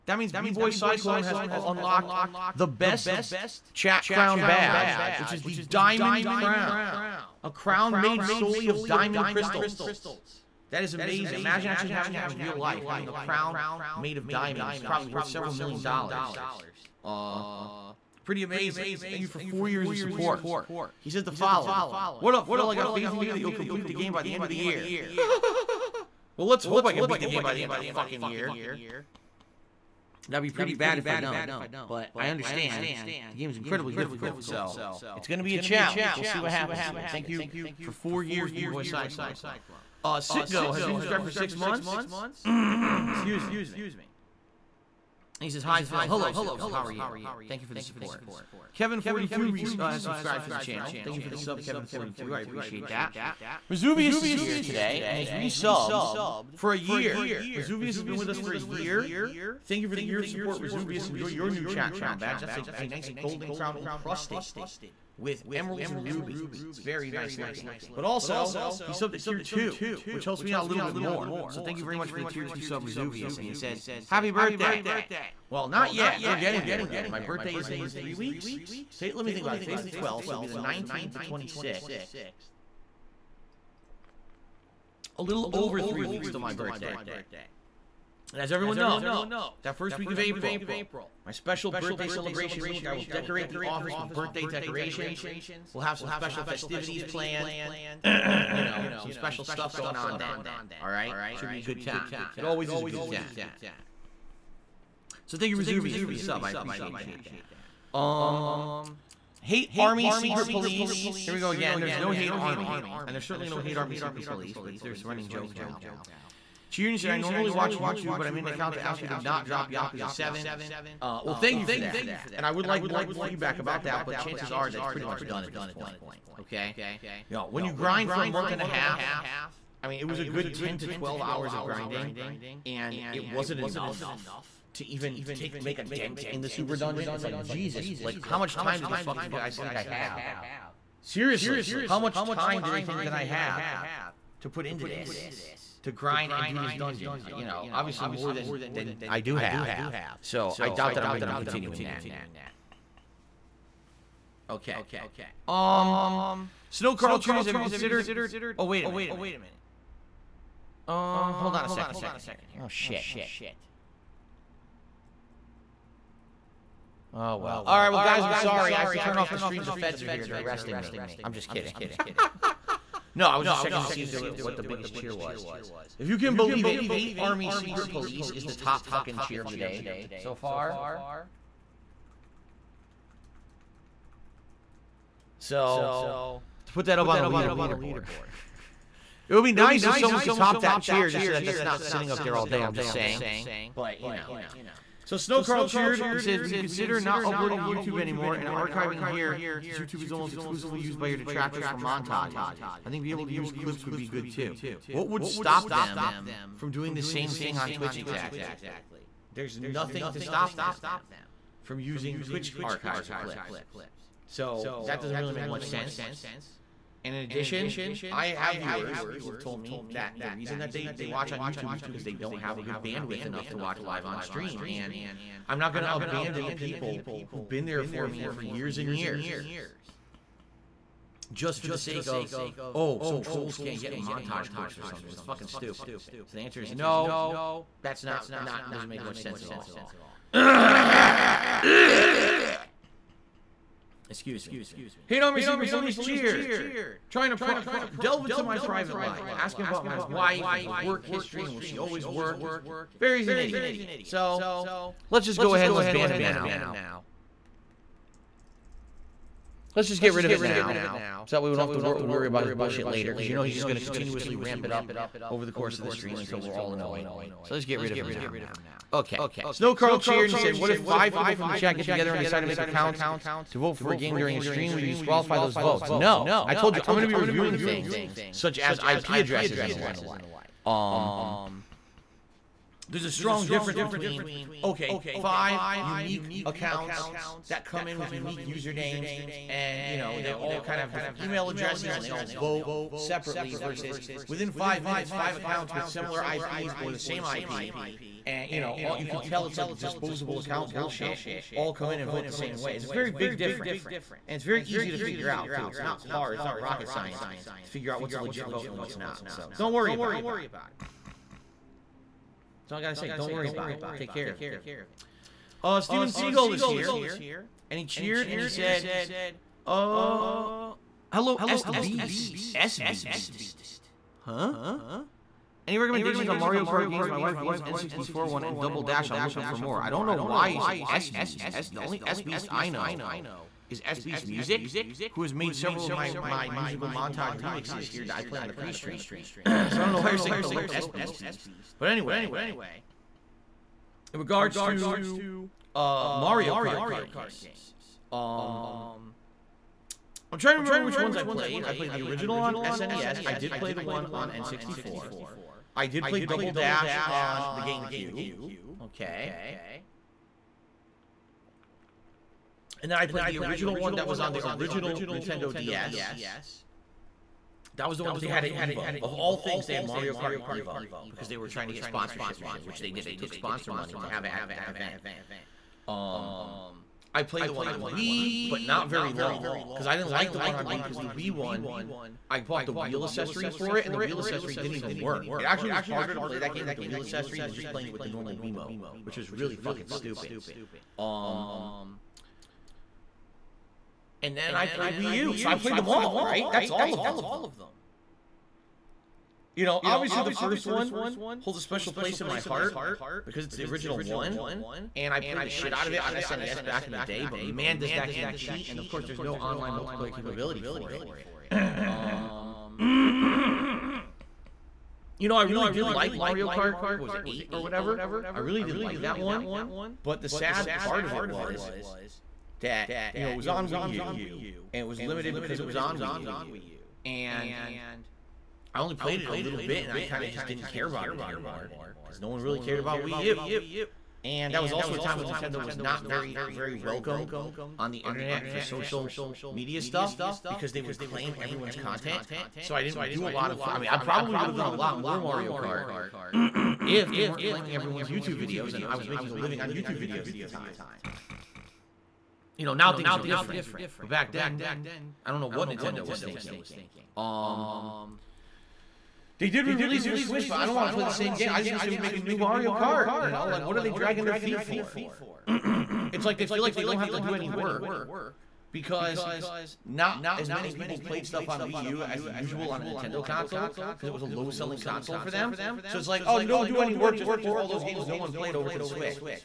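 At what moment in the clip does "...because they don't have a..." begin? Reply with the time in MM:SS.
03:41.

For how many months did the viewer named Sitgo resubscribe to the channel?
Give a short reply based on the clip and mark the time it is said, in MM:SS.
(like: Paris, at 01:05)
6, at 00:41.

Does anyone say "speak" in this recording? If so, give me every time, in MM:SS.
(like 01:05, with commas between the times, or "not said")
not said.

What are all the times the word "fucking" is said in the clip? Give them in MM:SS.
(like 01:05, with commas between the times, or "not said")
00:27, 02:18, 02:58, 03:55, 06:29.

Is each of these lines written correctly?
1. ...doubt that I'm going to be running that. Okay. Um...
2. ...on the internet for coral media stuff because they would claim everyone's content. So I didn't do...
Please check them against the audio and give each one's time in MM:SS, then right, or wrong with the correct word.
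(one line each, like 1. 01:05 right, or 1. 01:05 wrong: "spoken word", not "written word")
1. 02:30 wrong: "continuing", not "running"
2. 07:17 wrong: "social", not "coral".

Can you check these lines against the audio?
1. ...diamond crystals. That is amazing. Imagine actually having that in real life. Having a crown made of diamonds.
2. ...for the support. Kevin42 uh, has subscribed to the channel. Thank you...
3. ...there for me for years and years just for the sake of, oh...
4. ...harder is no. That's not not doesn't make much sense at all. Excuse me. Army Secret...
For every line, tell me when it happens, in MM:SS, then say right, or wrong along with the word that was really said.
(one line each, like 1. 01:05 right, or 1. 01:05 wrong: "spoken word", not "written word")
1. 00:08 right
2. 00:47 right
3. 03:47 right
4. 03:56 wrong: "answer", not "harder".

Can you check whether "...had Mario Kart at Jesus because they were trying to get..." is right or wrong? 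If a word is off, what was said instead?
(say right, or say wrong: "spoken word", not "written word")
wrong: "Evo", not "Jesus".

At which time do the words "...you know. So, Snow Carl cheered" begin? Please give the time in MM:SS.
03:14.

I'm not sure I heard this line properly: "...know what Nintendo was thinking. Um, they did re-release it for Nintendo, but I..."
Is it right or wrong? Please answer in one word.
wrong.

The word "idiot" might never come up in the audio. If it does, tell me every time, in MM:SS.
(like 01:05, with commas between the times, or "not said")
04:13.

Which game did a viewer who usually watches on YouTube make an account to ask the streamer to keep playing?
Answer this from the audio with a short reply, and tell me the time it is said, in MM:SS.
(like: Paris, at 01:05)
Yakuza 7, at 01:59.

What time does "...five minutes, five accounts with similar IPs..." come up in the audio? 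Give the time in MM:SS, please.
04:54.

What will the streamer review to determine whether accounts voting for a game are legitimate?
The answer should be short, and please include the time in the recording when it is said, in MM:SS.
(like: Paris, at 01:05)
IP addresses, at 04:38.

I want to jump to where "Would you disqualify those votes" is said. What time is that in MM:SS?
04:34.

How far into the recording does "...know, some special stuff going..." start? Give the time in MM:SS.
01:38.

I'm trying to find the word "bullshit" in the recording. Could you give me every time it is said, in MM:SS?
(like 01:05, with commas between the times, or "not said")
04:22, 05:00.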